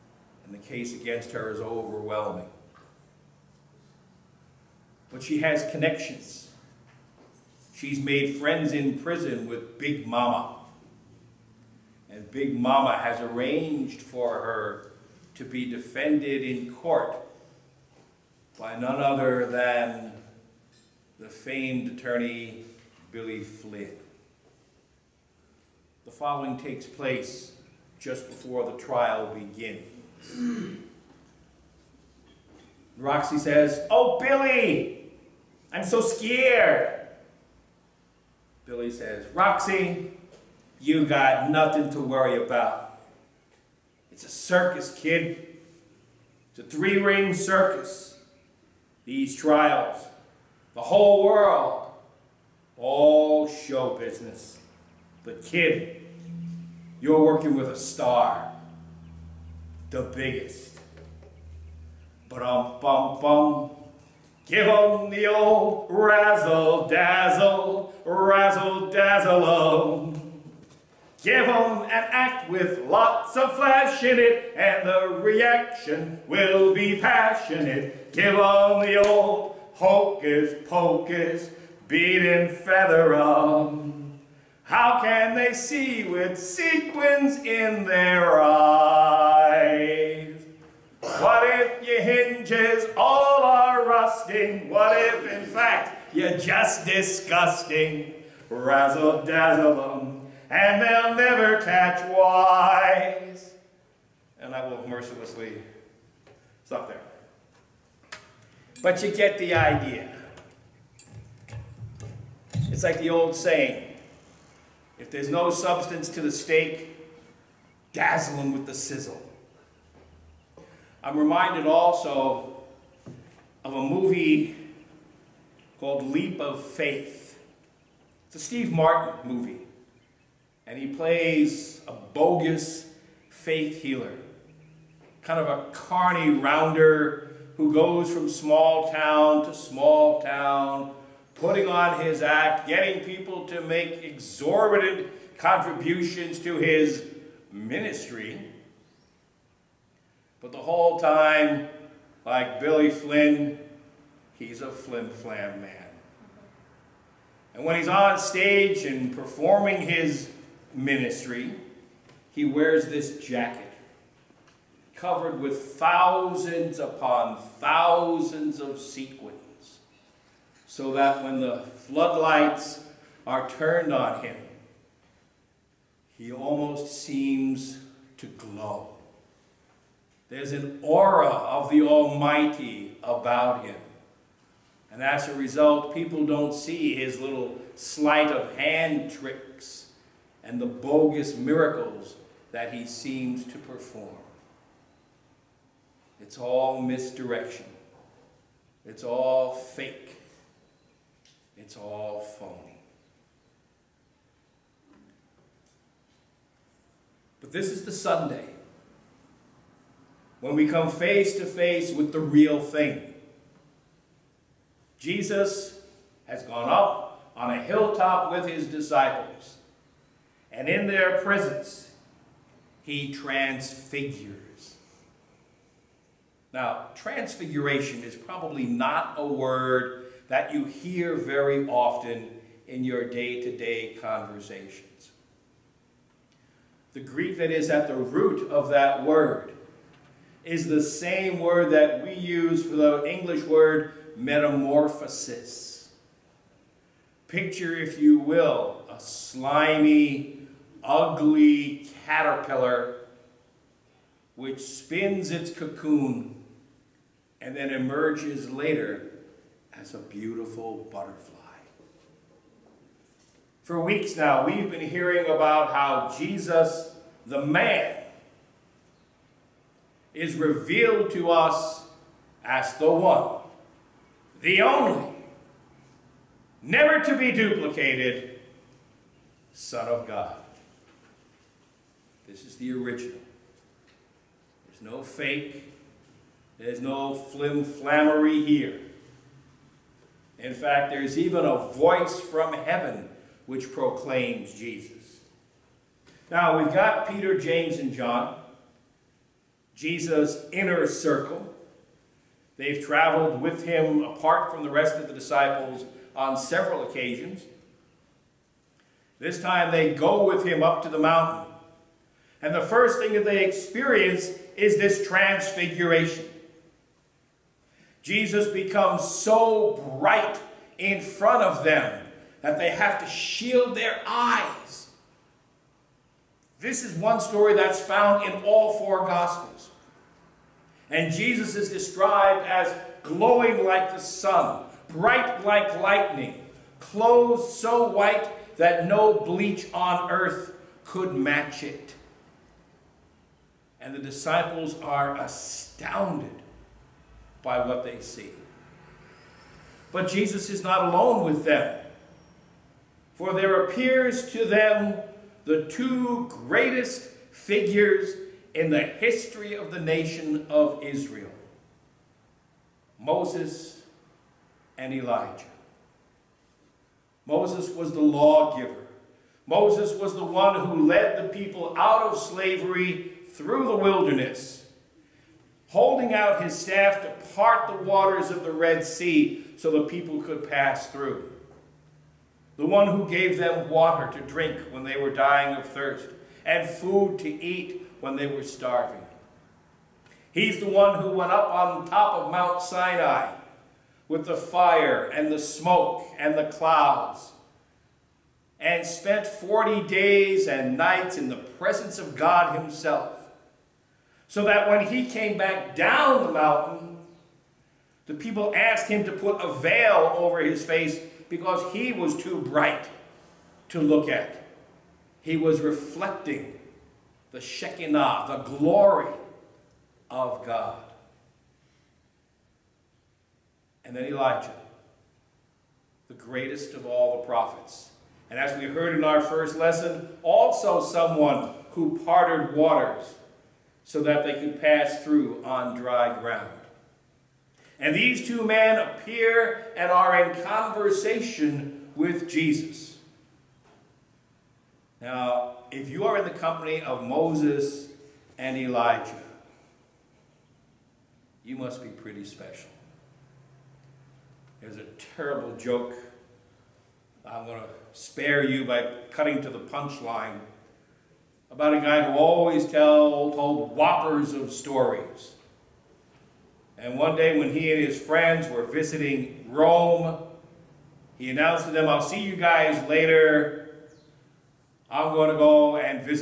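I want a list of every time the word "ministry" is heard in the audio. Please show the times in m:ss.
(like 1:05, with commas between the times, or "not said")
2:27, 2:40.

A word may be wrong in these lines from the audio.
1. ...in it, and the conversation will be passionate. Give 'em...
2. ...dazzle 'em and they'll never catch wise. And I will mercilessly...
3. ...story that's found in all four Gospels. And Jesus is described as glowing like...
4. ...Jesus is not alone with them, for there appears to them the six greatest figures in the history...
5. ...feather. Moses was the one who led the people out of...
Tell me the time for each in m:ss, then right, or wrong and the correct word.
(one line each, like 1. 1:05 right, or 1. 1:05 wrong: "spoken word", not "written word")
1. 1:14 wrong: "reaction", not "conversation"
2. 1:39 right
3. 5:27 right
4. 5:50 wrong: "two", not "six"
5. 6:08 wrong: "lawgiver", not "feather".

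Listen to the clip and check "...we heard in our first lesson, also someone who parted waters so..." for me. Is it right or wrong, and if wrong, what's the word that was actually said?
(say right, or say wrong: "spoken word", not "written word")
right.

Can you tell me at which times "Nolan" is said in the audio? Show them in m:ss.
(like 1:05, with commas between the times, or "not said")
not said.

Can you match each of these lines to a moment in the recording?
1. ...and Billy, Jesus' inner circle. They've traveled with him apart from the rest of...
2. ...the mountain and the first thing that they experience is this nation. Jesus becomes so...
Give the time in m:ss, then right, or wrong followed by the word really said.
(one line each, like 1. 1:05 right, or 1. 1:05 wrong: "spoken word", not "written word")
1. 4:57 wrong: "John", not "Billy"
2. 5:10 wrong: "transfiguration", not "nation".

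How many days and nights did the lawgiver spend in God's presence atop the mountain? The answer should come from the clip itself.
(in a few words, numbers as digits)
40.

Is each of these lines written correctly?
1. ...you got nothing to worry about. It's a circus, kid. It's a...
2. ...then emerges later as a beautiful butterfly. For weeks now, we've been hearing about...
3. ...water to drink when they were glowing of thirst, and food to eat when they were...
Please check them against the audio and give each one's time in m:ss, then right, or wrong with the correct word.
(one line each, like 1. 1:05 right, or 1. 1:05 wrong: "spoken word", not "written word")
1. 0:40 right
2. 4:17 right
3. 6:23 wrong: "dying", not "glowing".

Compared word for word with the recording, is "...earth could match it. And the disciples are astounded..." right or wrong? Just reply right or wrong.
right.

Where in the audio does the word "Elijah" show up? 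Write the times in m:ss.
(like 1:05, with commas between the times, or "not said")
6:04, 7:04, 7:28.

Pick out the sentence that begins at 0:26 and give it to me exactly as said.
The following takes place just before the trial begins.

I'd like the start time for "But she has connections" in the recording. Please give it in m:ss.
0:05.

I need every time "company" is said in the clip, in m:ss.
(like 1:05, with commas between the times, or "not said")
7:26.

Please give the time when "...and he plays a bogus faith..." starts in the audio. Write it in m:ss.
2:10.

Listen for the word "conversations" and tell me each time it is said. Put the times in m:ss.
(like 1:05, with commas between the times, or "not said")
3:54, 7:20.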